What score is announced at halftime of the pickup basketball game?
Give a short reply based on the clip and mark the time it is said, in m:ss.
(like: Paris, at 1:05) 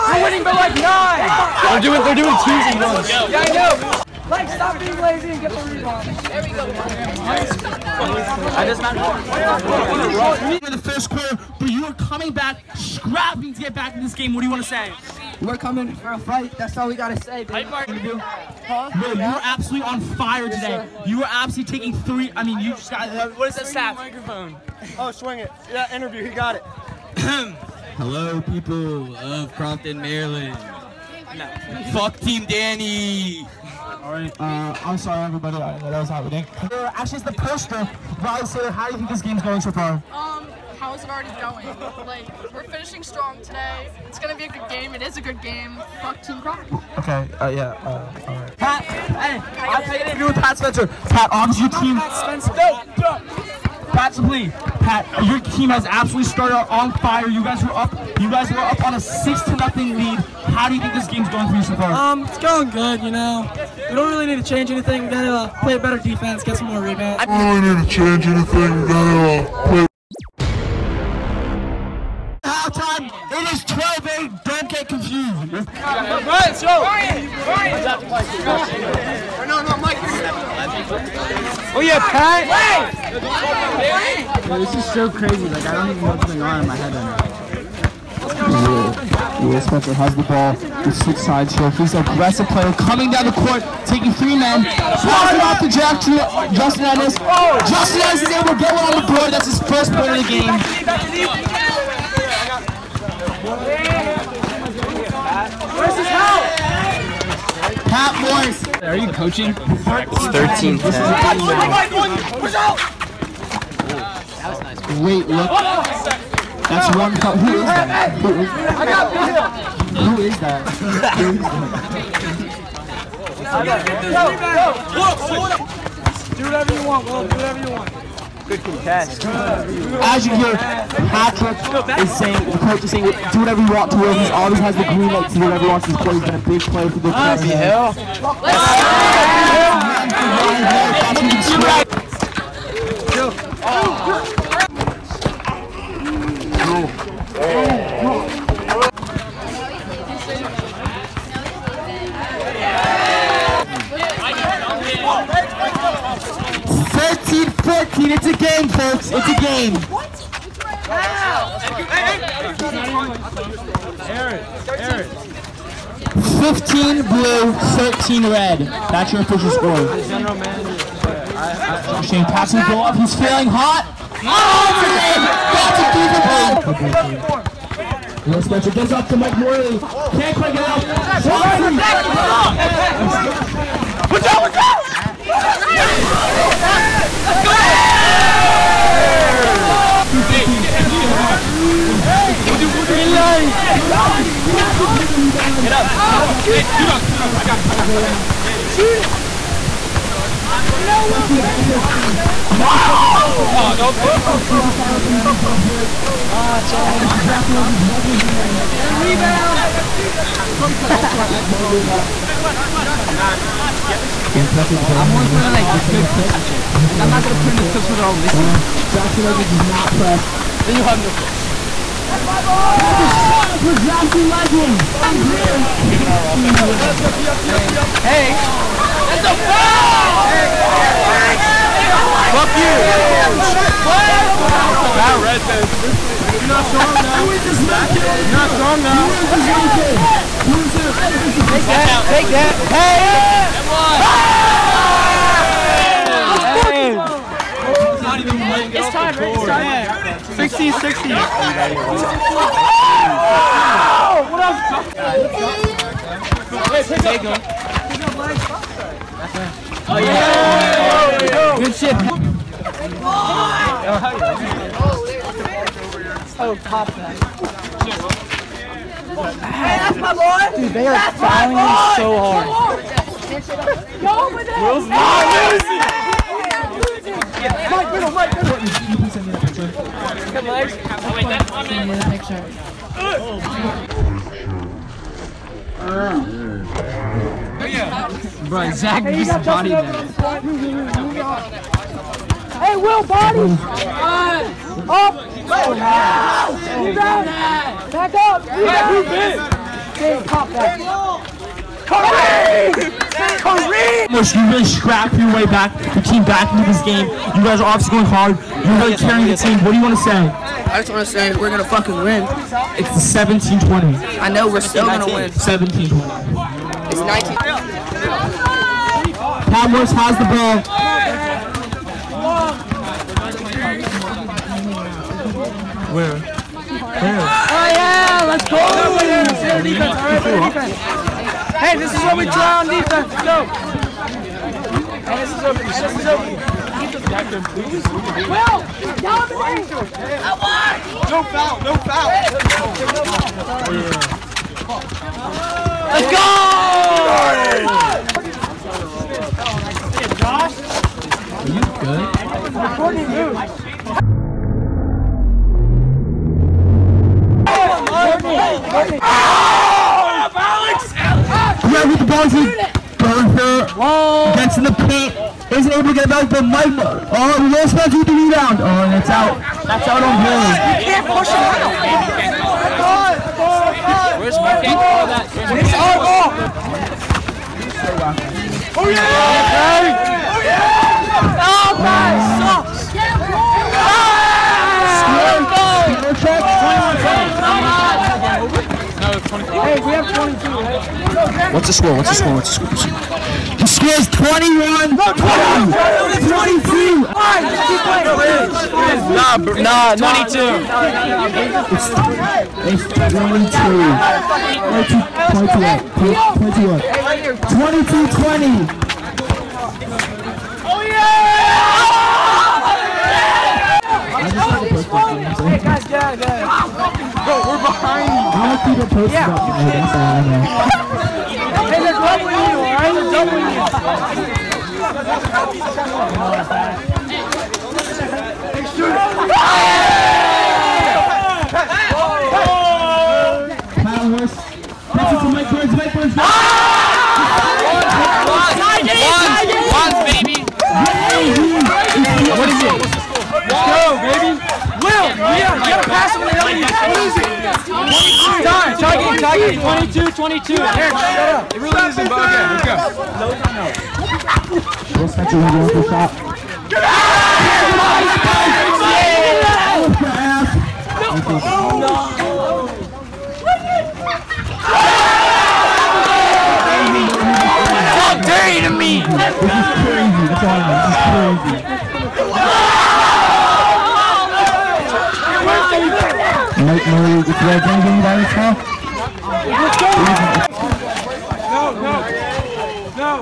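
12-8, at 1:13.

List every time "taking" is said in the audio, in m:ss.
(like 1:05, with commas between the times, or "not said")
0:21, 1:33.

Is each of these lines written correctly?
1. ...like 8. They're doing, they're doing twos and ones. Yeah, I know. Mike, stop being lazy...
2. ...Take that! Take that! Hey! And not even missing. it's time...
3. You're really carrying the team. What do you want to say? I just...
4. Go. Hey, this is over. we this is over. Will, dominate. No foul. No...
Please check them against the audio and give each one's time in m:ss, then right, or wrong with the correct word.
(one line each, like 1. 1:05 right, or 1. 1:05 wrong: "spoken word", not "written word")
1. 0:00 wrong: "9", not "8"
2. 4:01 wrong: "playing", not "missing"
3. 5:08 right
4. 5:33 right.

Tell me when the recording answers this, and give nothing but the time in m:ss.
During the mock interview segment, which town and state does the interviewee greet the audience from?
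0:29.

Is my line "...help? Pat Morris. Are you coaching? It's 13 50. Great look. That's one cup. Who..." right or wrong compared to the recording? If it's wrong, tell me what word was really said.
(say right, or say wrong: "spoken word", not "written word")
wrong: "10", not "50".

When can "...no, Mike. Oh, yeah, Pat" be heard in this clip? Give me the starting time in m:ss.
1:19.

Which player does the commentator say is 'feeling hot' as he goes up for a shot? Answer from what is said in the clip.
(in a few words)
Shane Paxton.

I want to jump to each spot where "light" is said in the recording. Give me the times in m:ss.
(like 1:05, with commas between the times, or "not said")
2:15.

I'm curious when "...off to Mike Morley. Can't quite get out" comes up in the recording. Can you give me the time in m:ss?
2:58.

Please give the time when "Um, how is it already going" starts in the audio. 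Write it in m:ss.
0:40.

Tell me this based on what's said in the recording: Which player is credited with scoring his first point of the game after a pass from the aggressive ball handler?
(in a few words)
Justin Edwards.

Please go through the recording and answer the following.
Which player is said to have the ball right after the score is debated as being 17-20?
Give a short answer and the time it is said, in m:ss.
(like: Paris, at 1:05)
Palmworth, at 5:19.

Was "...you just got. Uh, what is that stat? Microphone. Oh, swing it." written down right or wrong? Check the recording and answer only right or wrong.
right.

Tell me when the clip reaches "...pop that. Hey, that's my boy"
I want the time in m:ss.
4:26.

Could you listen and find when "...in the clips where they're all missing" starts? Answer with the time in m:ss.
3:37.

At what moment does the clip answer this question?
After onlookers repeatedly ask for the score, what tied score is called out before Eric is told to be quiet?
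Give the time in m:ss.
7:30.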